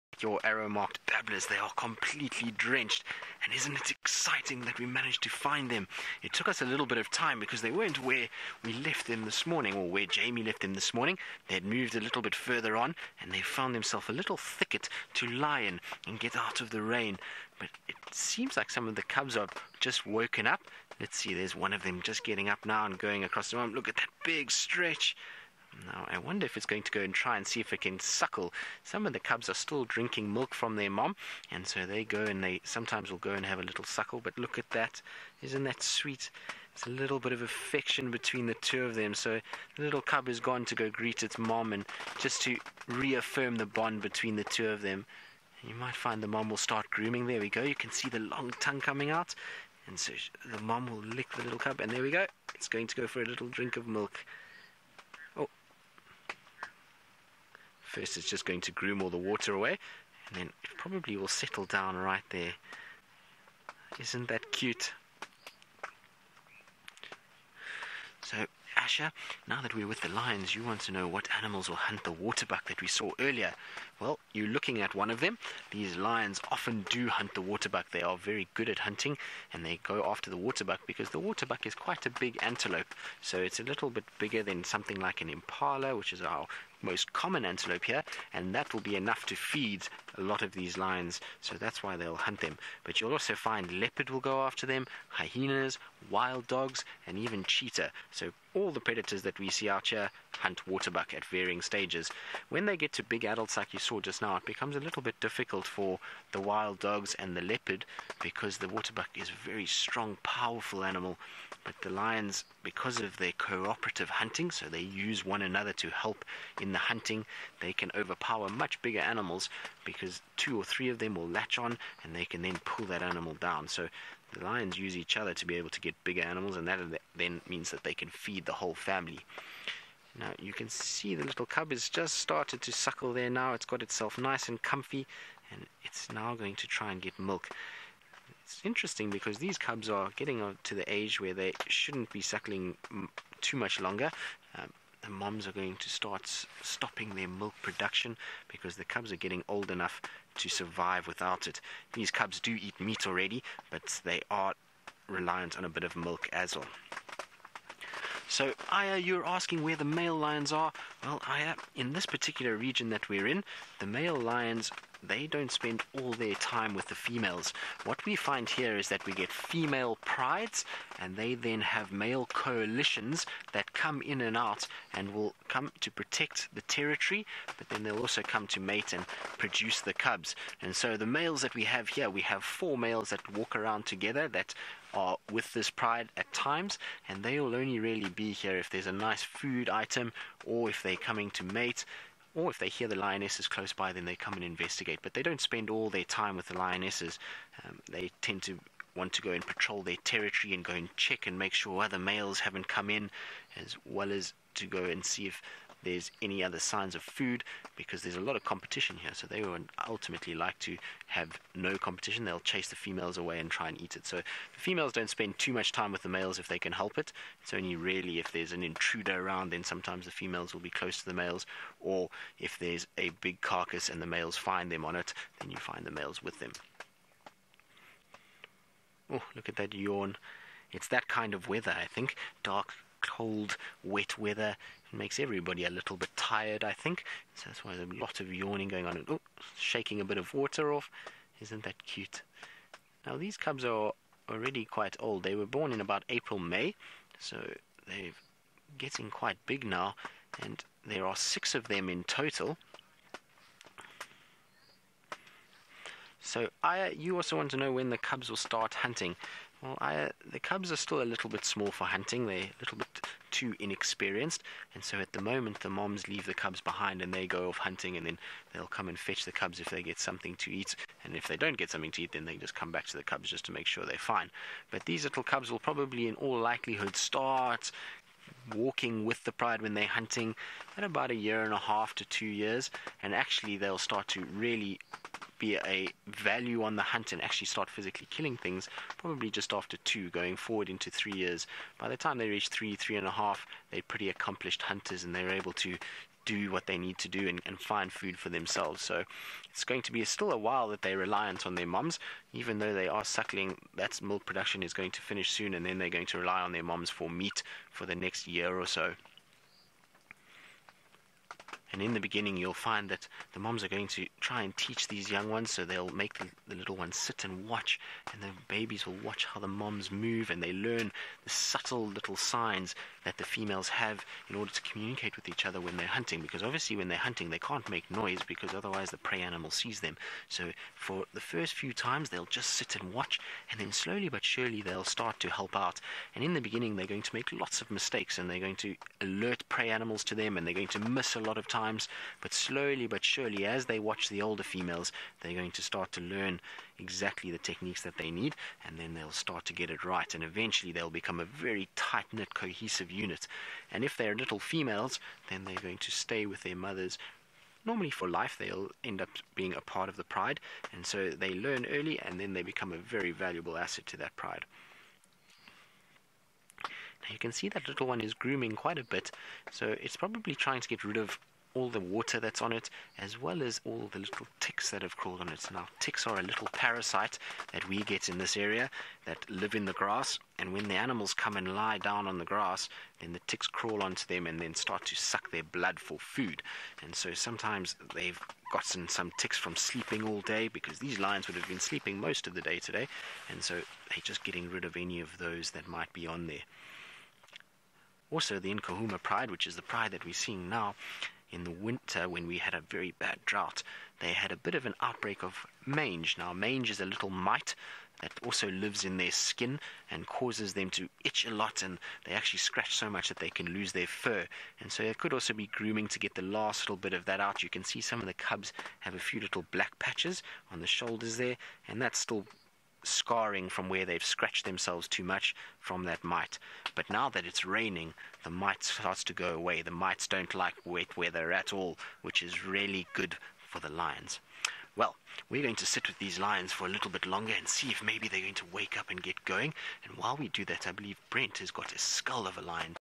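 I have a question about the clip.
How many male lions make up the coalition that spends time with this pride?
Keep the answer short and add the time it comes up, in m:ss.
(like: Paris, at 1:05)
4, at 3:02.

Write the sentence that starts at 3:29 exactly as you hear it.
So they would ultimately like to have no competition.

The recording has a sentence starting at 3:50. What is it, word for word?
It's that kind of weather, I think.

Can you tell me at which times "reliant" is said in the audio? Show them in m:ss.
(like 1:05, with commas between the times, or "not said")
2:35, 5:00.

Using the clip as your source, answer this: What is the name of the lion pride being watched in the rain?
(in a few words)
Nkuhuma pride.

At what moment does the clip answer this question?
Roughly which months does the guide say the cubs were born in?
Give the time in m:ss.
4:06.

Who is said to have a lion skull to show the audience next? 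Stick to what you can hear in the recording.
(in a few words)
Brent.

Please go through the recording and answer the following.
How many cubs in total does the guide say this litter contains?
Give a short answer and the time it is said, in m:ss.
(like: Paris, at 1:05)
6, at 4:11.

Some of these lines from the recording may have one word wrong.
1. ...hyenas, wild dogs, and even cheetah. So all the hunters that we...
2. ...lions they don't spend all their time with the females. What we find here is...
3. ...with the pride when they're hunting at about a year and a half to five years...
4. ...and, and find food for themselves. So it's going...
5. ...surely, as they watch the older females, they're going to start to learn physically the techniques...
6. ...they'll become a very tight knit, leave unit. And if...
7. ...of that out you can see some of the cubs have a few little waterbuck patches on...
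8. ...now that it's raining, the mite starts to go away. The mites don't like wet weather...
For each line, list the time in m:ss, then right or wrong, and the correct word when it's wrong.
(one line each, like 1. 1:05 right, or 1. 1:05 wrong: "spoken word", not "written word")
1. 1:35 wrong: "predators", not "hunters"
2. 2:44 right
3. 4:39 wrong: "two", not "five"
4. 4:57 right
5. 5:43 wrong: "exactly", not "physically"
6. 5:50 wrong: "cohesive", not "leave"
7. 6:56 wrong: "black", not "waterbuck"
8. 7:06 right.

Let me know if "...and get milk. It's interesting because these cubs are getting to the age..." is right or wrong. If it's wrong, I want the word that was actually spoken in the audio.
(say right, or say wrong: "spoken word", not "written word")
right.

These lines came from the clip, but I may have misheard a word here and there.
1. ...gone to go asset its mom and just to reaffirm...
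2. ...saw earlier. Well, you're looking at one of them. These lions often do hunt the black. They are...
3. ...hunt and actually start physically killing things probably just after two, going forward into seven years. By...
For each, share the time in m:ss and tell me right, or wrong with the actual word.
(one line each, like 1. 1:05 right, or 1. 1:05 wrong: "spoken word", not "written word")
1. 0:40 wrong: "greet", not "asset"
2. 1:12 wrong: "waterbuck", not "black"
3. 4:46 wrong: "three", not "seven".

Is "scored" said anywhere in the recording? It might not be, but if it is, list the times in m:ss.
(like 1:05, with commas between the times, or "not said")
not said.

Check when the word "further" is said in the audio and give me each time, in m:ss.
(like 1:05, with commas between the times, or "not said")
0:12.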